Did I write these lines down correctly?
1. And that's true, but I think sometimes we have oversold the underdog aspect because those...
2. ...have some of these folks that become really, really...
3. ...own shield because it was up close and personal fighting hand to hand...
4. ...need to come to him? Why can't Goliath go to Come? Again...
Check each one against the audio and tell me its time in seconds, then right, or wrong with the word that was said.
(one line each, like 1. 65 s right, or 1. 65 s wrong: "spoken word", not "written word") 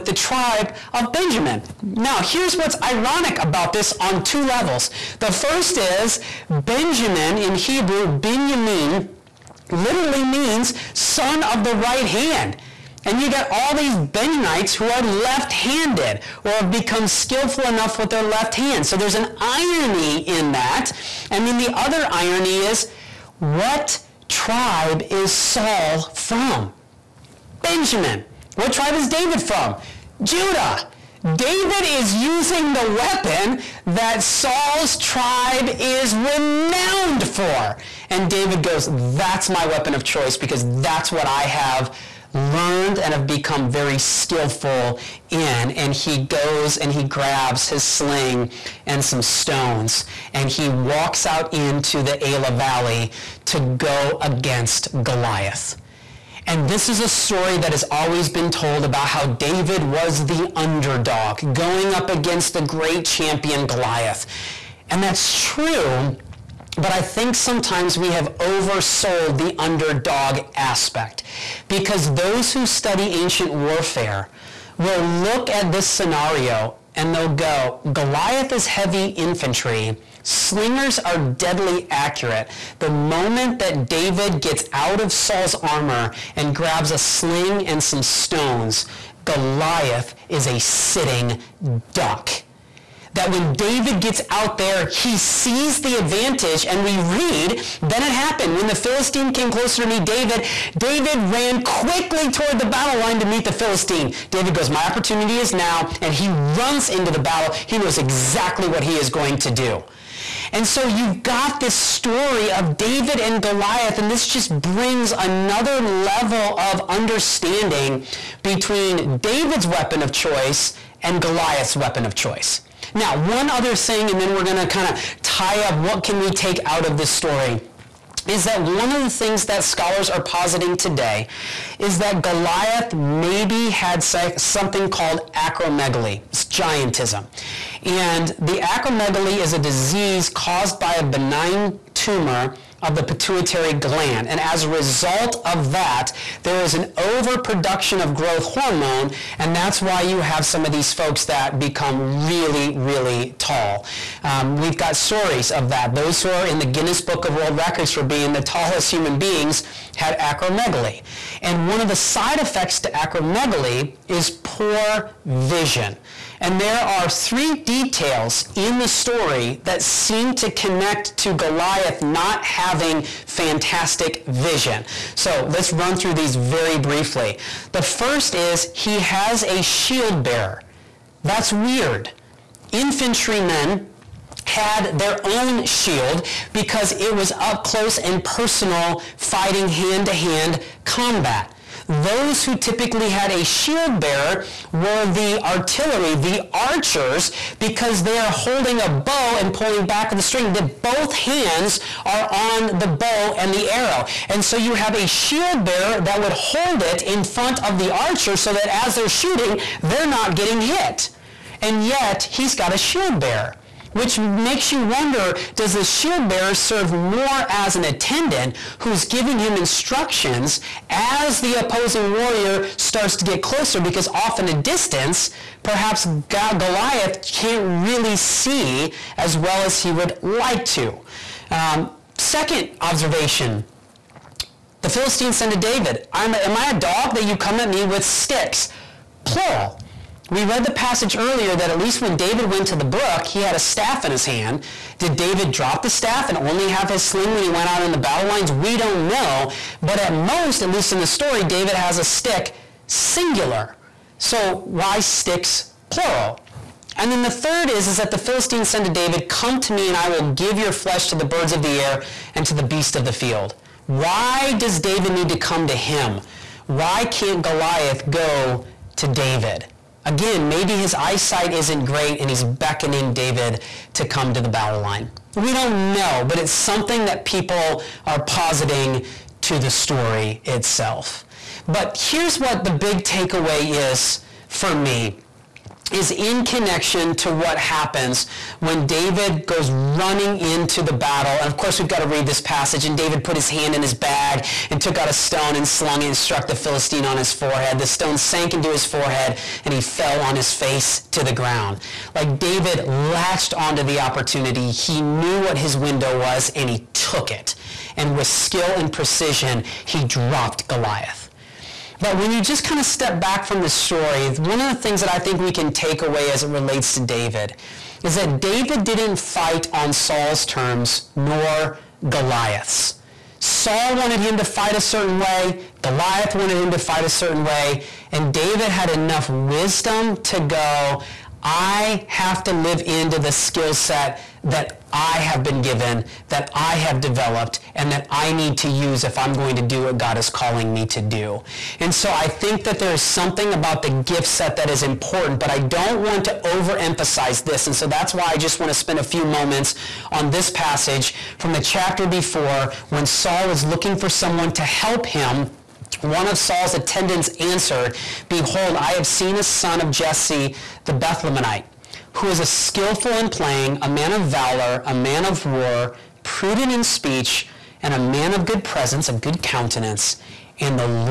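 1. 64 s right
2. 150 s right
3. 185 s right
4. 265 s wrong: "David", not "Come".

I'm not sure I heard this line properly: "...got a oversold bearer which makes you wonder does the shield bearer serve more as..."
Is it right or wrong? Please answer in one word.
wrong.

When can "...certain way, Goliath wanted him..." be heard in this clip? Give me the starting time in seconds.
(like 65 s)
324 s.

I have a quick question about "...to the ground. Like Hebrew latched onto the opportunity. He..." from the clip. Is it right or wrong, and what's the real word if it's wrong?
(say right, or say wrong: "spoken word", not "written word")
wrong: "David", not "Hebrew".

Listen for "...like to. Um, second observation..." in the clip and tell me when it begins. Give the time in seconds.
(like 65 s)
230 s.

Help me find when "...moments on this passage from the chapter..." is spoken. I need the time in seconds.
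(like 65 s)
349 s.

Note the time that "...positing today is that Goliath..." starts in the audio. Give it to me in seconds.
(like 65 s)
130 s.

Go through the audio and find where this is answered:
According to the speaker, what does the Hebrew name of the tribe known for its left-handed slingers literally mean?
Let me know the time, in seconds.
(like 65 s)
10 s.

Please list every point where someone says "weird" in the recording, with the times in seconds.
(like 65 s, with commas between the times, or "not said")
181 s.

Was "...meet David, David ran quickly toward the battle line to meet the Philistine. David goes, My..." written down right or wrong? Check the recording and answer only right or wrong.
right.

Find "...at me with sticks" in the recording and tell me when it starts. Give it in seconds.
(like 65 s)
237 s.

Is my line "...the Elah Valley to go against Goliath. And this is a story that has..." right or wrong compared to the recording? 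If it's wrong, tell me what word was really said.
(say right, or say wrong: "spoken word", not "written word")
right.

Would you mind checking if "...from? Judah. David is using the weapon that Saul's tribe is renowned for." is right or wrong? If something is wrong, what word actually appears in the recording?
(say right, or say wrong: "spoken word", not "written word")
right.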